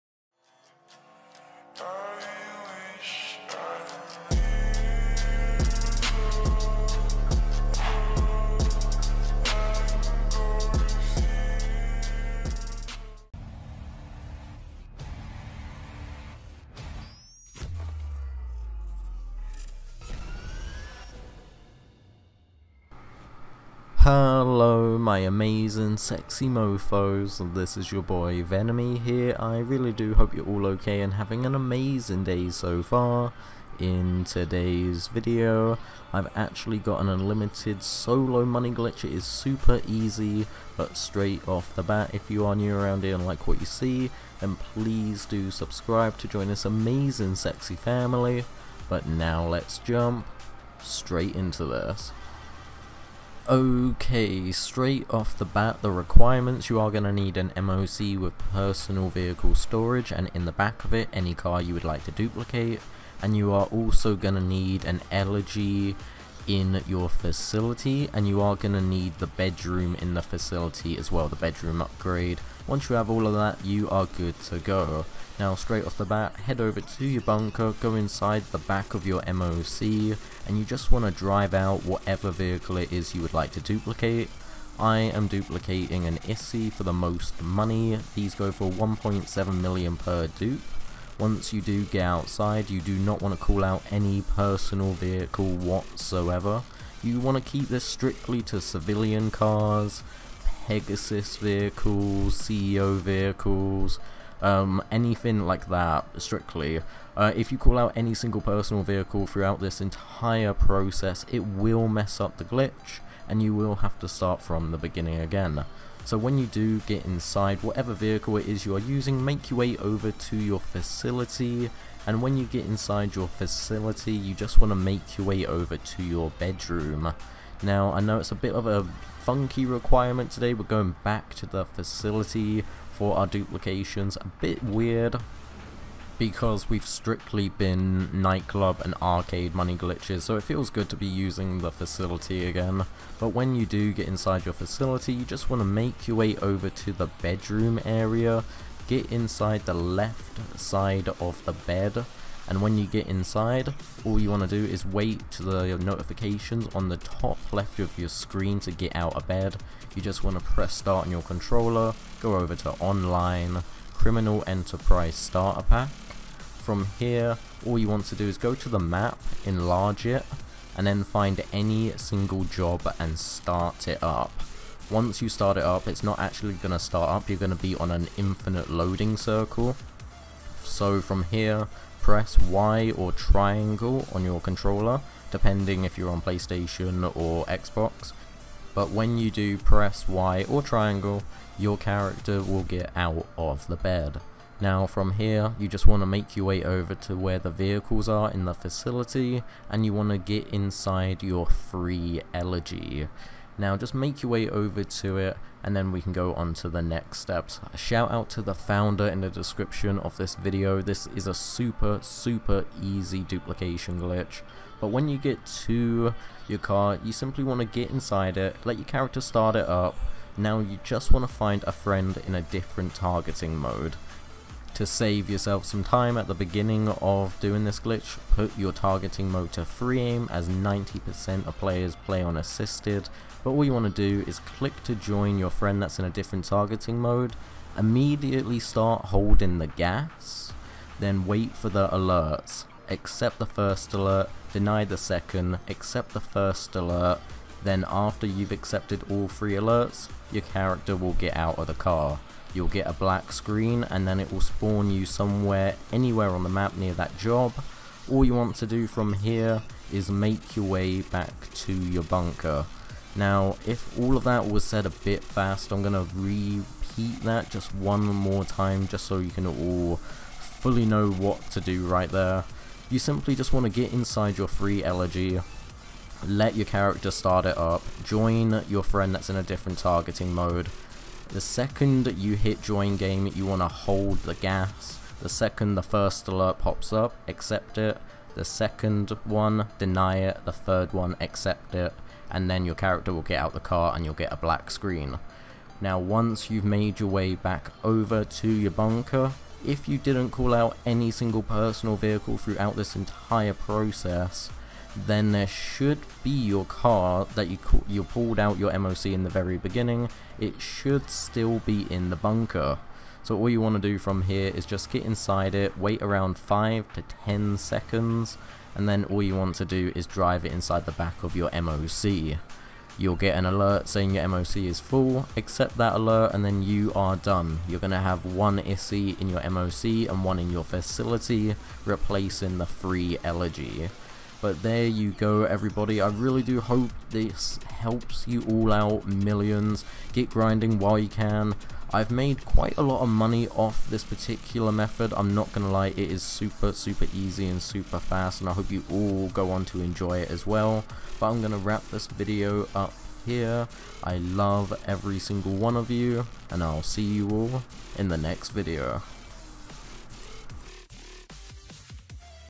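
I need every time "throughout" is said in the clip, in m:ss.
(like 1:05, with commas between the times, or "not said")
1:49, 5:02.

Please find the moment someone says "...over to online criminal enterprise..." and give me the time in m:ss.
2:42.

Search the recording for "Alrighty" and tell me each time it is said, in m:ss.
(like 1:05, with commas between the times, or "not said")
not said.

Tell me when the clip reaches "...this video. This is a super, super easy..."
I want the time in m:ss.
3:30.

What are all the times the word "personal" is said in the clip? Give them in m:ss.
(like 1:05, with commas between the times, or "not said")
0:58, 1:34, 1:48, 5:01.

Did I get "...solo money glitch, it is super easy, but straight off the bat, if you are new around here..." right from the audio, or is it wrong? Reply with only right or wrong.
right.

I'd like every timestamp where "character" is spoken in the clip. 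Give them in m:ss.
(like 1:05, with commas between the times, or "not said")
3:11, 3:38, 4:10, 4:36, 4:52.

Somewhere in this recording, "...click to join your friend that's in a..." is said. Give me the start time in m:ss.
3:54.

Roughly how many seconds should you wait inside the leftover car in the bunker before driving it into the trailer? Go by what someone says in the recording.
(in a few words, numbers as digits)
5 to 10.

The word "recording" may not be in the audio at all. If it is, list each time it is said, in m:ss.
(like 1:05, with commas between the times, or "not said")
not said.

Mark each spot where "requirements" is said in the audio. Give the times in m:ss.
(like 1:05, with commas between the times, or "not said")
0:55, 2:09.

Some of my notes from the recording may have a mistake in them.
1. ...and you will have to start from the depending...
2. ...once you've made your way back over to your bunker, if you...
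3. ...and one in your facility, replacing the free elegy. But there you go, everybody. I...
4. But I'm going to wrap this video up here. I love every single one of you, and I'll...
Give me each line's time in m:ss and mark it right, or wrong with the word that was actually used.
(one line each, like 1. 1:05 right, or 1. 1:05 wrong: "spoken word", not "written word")
1. 1:53 wrong: "beginning", not "depending"
2. 4:55 right
3. 5:30 right
4. 5:51 right.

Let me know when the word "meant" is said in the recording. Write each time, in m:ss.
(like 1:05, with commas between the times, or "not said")
not said.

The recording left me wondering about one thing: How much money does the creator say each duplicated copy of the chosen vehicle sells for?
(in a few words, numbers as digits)
1.7 million.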